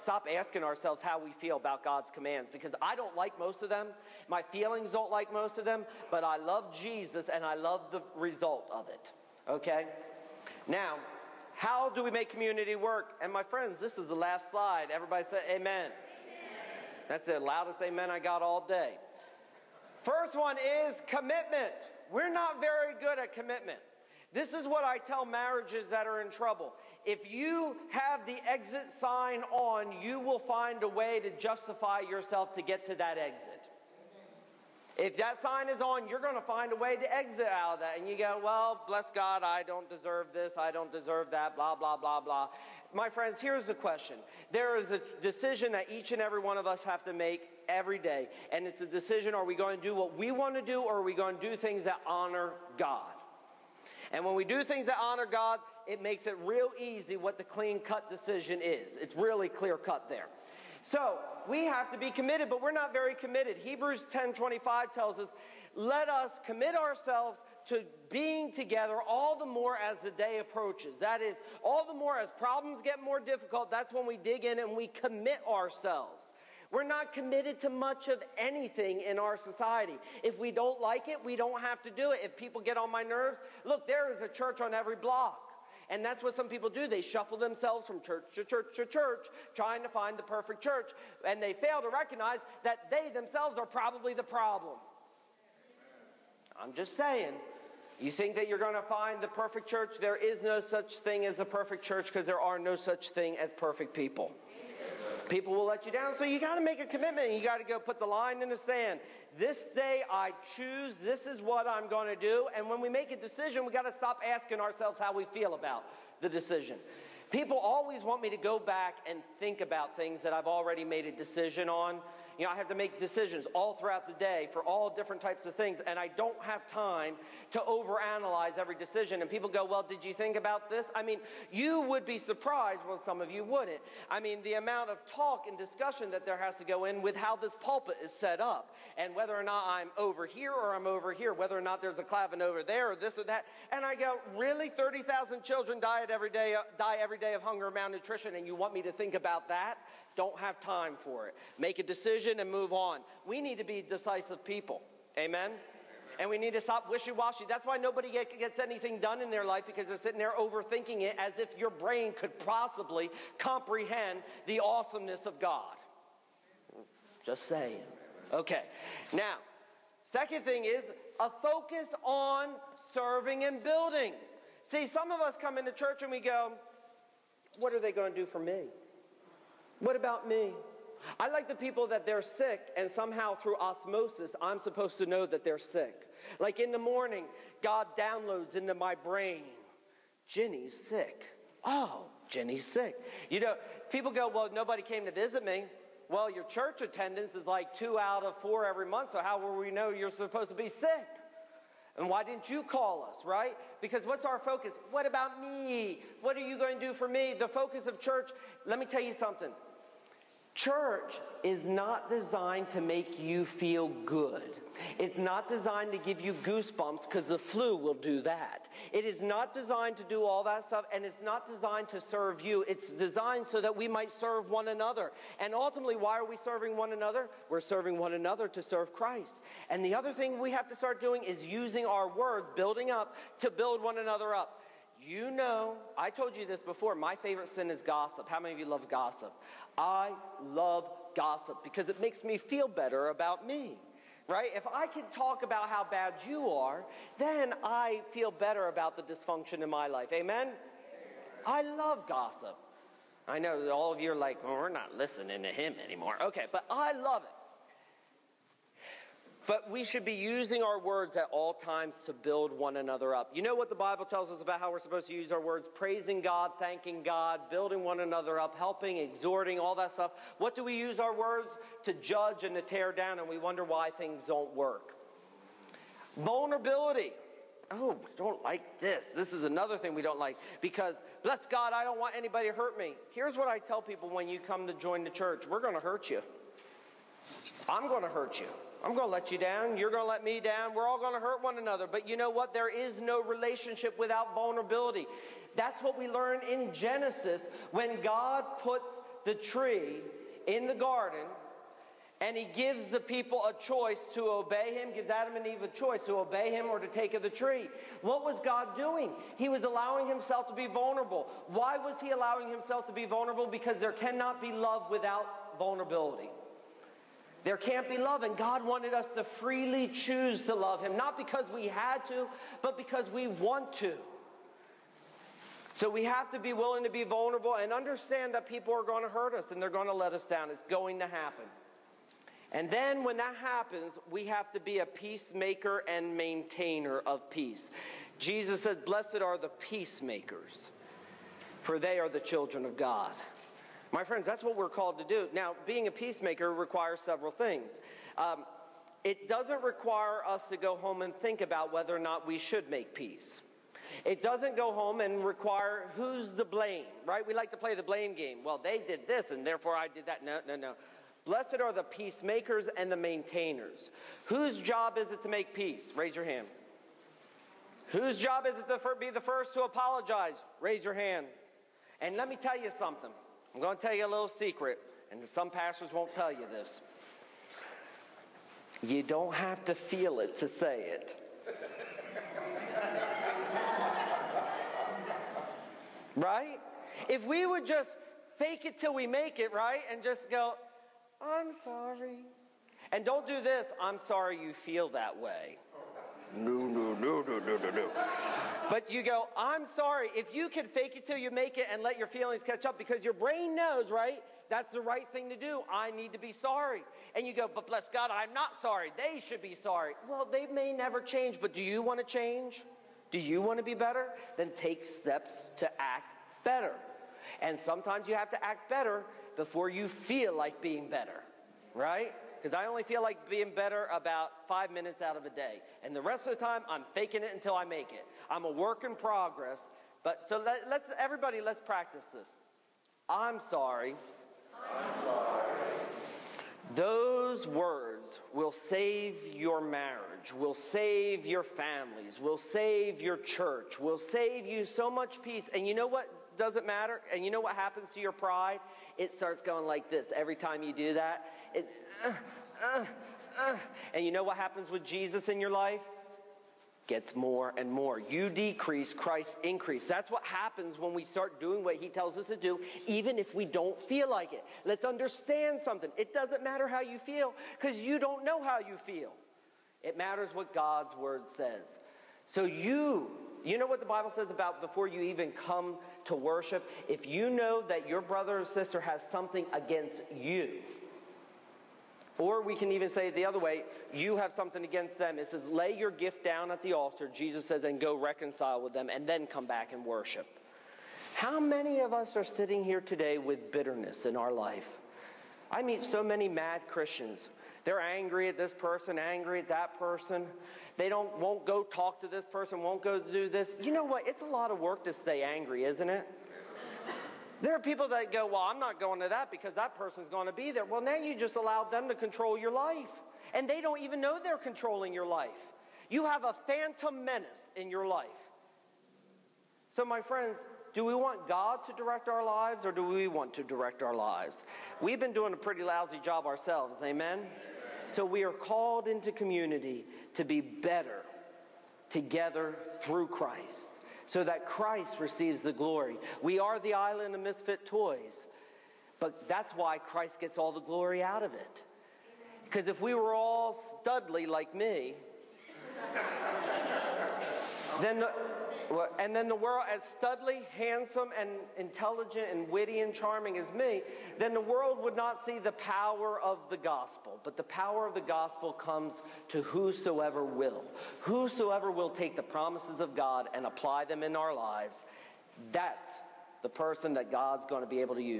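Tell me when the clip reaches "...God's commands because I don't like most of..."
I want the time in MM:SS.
00:01.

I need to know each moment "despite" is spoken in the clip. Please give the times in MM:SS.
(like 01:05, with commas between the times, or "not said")
not said.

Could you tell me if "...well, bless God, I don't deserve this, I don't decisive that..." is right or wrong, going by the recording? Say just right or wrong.
wrong.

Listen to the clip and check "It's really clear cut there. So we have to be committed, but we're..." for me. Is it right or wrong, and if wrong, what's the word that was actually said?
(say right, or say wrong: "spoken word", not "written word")
right.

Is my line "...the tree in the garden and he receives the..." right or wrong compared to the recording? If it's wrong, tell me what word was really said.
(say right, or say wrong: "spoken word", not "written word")
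wrong: "gives", not "receives".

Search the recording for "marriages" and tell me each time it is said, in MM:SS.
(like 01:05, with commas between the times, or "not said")
00:25, 07:19.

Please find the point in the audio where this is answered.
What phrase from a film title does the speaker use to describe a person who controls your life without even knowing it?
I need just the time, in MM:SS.
08:36.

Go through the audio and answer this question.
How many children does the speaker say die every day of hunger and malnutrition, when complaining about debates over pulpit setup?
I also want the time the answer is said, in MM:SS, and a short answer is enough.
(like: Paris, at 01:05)
30,000, at 02:24.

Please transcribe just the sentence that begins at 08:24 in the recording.
It's a lot of work to stay angry, isn't it?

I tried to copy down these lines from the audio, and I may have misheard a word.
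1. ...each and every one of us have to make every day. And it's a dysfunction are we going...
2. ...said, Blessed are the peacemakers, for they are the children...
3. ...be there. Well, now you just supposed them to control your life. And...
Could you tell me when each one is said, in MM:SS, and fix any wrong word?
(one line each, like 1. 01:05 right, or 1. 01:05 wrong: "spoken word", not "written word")
1. 00:45 wrong: "decision", not "dysfunction"
2. 05:38 right
3. 08:30 wrong: "allowed", not "supposed".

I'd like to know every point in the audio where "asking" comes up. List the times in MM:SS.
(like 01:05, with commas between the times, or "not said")
00:00, 01:54.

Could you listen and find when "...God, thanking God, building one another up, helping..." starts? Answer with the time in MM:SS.
04:26.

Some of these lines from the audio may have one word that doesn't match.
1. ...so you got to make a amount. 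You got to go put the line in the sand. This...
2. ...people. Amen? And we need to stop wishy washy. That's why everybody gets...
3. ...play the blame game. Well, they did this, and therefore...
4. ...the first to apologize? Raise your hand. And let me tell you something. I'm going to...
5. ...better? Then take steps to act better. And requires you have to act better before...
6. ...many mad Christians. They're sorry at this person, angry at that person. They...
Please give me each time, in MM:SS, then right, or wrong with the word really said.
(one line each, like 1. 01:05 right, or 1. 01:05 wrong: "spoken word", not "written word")
1. 01:46 wrong: "commitment", not "amount"
2. 02:34 wrong: "nobody", not "everybody"
3. 05:57 right
4. 06:09 right
5. 06:53 wrong: "sometimes", not "requires"
6. 08:16 wrong: "angry", not "sorry".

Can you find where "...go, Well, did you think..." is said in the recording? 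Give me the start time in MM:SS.
02:09.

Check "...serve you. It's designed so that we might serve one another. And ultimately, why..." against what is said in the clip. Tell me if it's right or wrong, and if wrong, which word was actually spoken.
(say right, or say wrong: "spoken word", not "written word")
right.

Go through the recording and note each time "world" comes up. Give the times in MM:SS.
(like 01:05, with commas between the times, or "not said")
09:09, 09:14.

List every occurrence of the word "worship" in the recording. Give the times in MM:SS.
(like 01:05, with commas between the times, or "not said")
07:56, 08:09.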